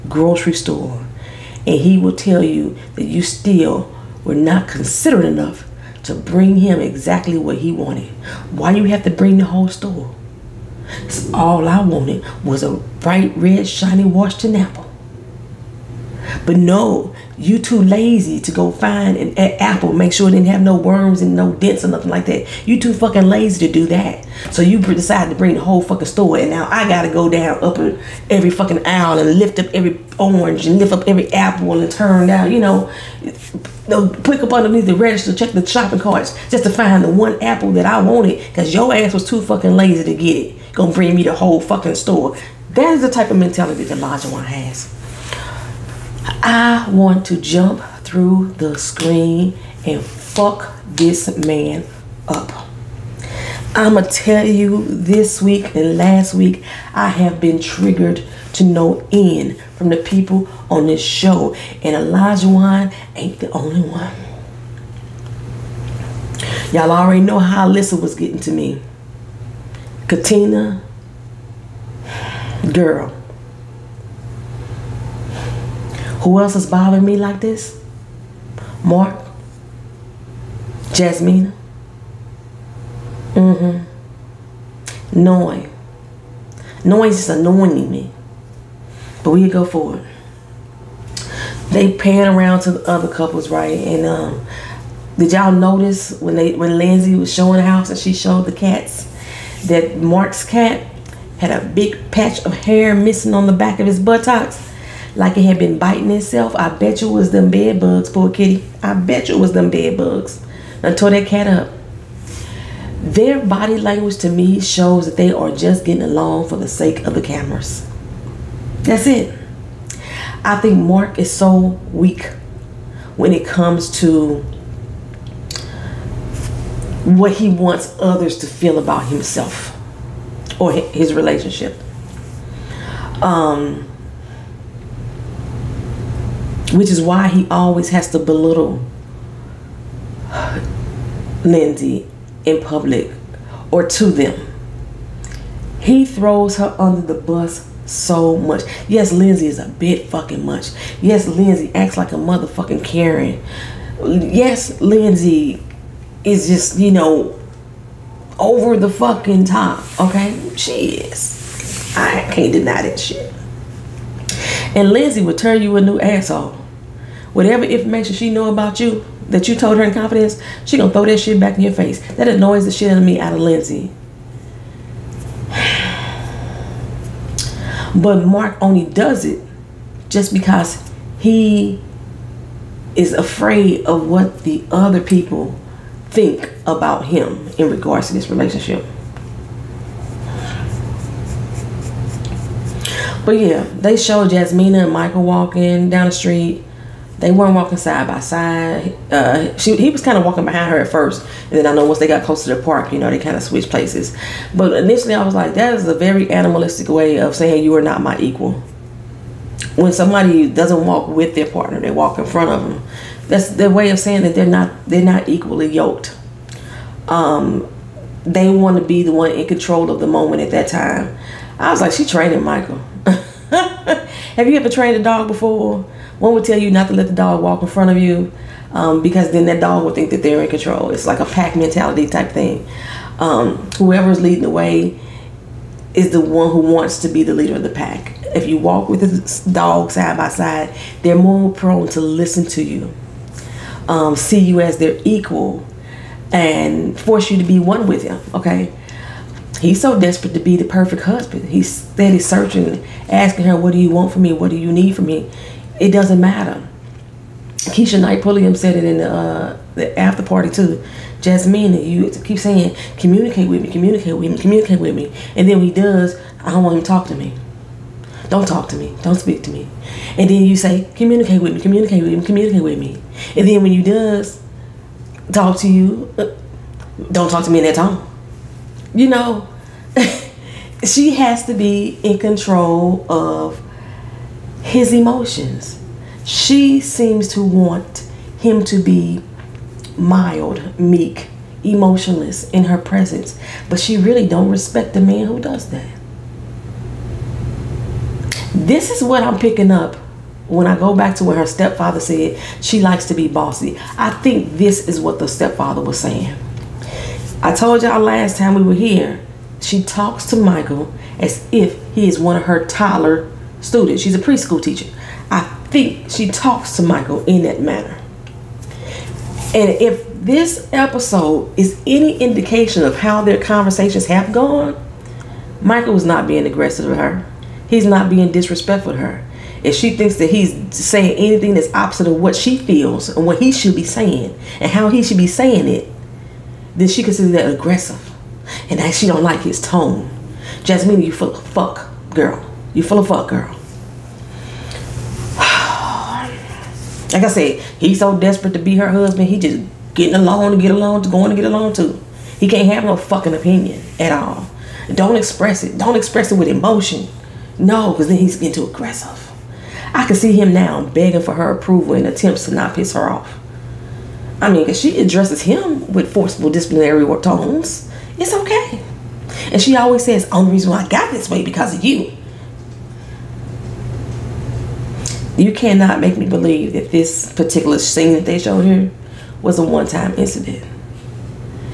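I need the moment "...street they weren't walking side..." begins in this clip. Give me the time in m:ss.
3:16.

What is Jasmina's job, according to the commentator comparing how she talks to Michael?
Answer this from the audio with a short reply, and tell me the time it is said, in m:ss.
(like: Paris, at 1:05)
Preschool teacher, at 5:14.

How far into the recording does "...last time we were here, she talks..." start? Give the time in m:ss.
5:08.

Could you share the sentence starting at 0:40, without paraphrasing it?
Gonna bring me the whole fucking store.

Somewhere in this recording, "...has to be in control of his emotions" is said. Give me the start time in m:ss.
4:41.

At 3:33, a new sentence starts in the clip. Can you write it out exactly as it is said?
That's their way of saying that they're not they're not equally yoked.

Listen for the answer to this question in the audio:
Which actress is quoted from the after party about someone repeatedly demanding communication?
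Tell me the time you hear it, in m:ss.
4:17.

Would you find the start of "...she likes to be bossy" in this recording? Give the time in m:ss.
5:02.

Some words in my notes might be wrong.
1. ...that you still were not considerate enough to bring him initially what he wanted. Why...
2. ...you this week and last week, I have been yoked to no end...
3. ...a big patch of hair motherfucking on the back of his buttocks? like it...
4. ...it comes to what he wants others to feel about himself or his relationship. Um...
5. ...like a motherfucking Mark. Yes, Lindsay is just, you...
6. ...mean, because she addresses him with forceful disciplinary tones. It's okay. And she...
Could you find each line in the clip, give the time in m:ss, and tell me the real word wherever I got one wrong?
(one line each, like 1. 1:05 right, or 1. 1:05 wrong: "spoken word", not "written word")
1. 0:02 wrong: "exactly", not "initially"
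2. 0:54 wrong: "triggered", not "yoked"
3. 1:41 wrong: "missing", not "motherfucking"
4. 2:03 right
5. 2:31 wrong: "Karen", not "Mark"
6. 6:04 right.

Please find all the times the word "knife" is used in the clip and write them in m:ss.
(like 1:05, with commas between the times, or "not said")
not said.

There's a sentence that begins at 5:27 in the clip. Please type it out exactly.
He's not being disrespectful to her.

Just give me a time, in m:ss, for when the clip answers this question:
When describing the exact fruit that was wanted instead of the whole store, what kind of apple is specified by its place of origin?
0:14.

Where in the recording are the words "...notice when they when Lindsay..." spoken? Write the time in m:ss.
1:35.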